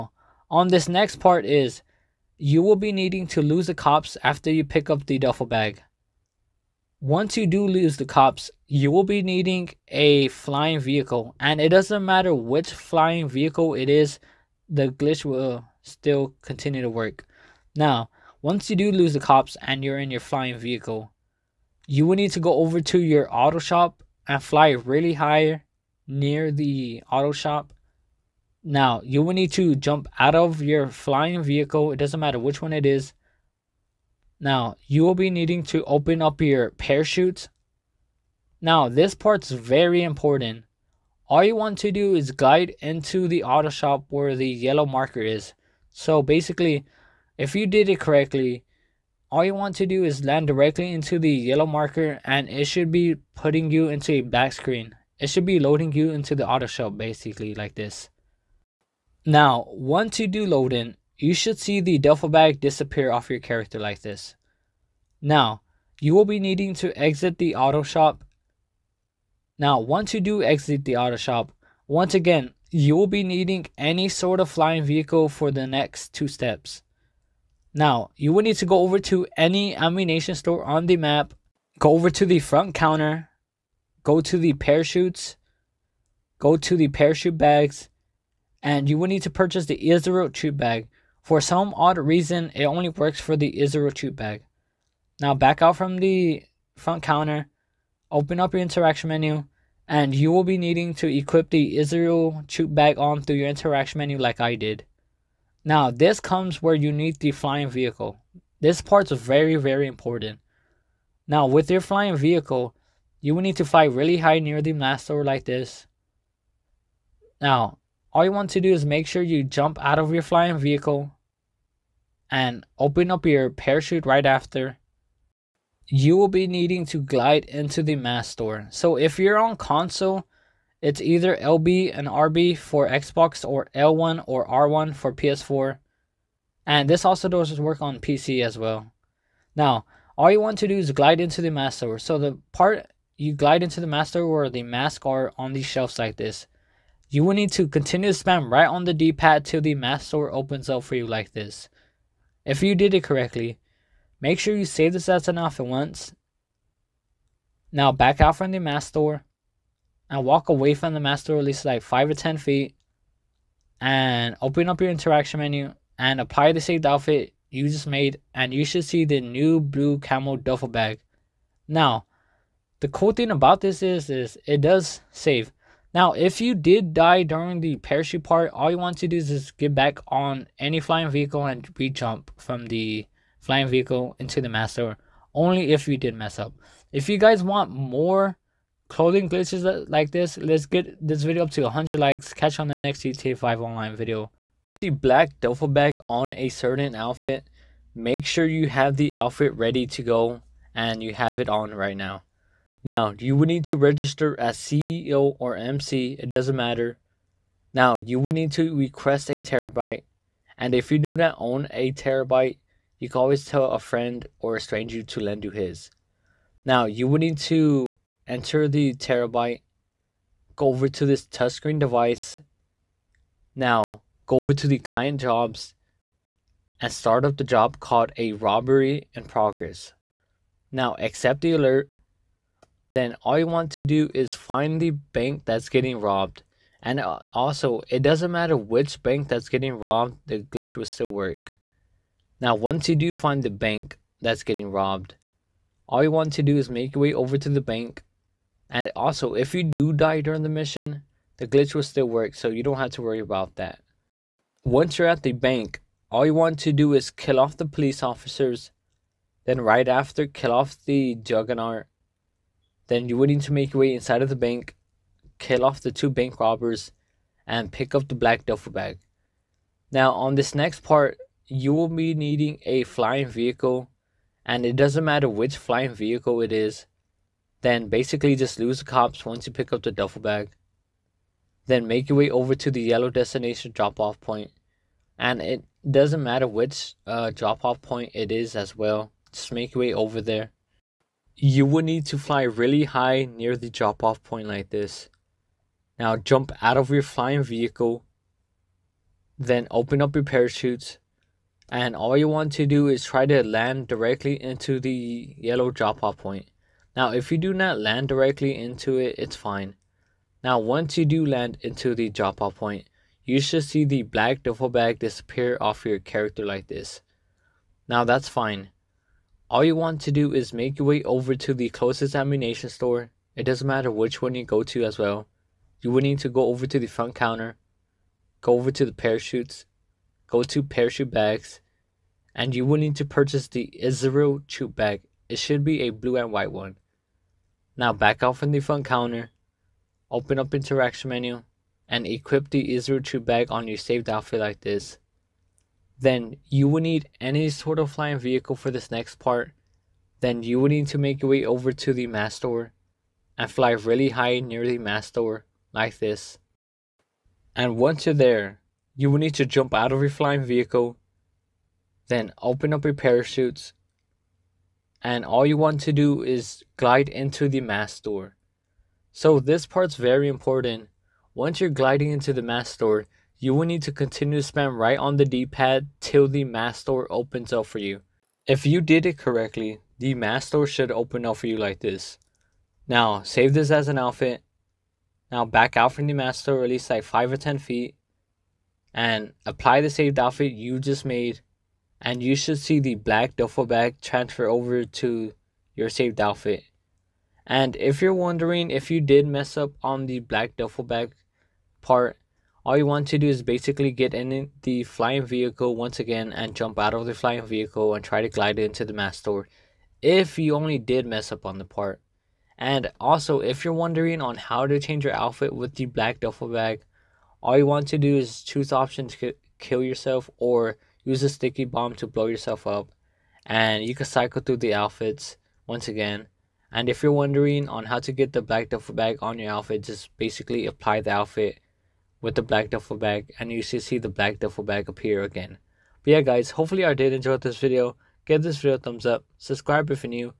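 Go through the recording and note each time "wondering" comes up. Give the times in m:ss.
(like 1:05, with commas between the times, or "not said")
6:38, 6:53, 7:07.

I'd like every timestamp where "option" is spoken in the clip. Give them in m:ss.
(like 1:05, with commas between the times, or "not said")
2:35, 6:58.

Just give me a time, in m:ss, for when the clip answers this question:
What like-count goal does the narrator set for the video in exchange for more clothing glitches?
3:11.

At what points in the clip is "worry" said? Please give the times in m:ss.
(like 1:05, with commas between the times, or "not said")
4:13.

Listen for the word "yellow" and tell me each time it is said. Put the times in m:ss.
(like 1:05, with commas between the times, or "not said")
0:44, 0:51, 4:42, 5:05.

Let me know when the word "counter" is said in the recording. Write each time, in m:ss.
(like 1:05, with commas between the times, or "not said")
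1:22, 1:37, 5:27, 5:38.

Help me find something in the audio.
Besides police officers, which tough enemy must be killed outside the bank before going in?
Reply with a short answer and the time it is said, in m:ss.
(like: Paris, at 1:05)
The juggernaut, at 4:21.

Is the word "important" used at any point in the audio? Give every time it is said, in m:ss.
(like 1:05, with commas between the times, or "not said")
0:40, 1:49, 6:10.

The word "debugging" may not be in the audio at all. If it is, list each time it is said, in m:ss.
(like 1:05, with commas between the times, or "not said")
not said.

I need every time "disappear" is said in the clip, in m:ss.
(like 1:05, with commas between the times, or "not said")
1:02, 5:14.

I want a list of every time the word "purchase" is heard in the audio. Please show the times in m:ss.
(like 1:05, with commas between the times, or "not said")
1:29, 5:33.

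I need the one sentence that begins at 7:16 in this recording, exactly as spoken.
But yeah guys, hopefully I did enjoy this video.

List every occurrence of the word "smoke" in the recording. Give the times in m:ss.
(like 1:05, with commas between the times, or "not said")
not said.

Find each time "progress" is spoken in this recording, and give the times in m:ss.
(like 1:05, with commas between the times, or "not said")
3:49.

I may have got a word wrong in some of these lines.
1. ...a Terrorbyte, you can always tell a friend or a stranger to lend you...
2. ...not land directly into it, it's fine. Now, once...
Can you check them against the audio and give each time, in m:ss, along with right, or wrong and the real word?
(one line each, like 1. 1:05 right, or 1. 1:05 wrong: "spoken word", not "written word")
1. 3:31 right
2. 5:07 right.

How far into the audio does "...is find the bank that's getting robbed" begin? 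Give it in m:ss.
3:54.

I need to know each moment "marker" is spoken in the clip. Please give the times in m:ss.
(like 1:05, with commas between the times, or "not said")
0:44, 0:51.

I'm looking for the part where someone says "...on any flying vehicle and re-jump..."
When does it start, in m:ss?
3:00.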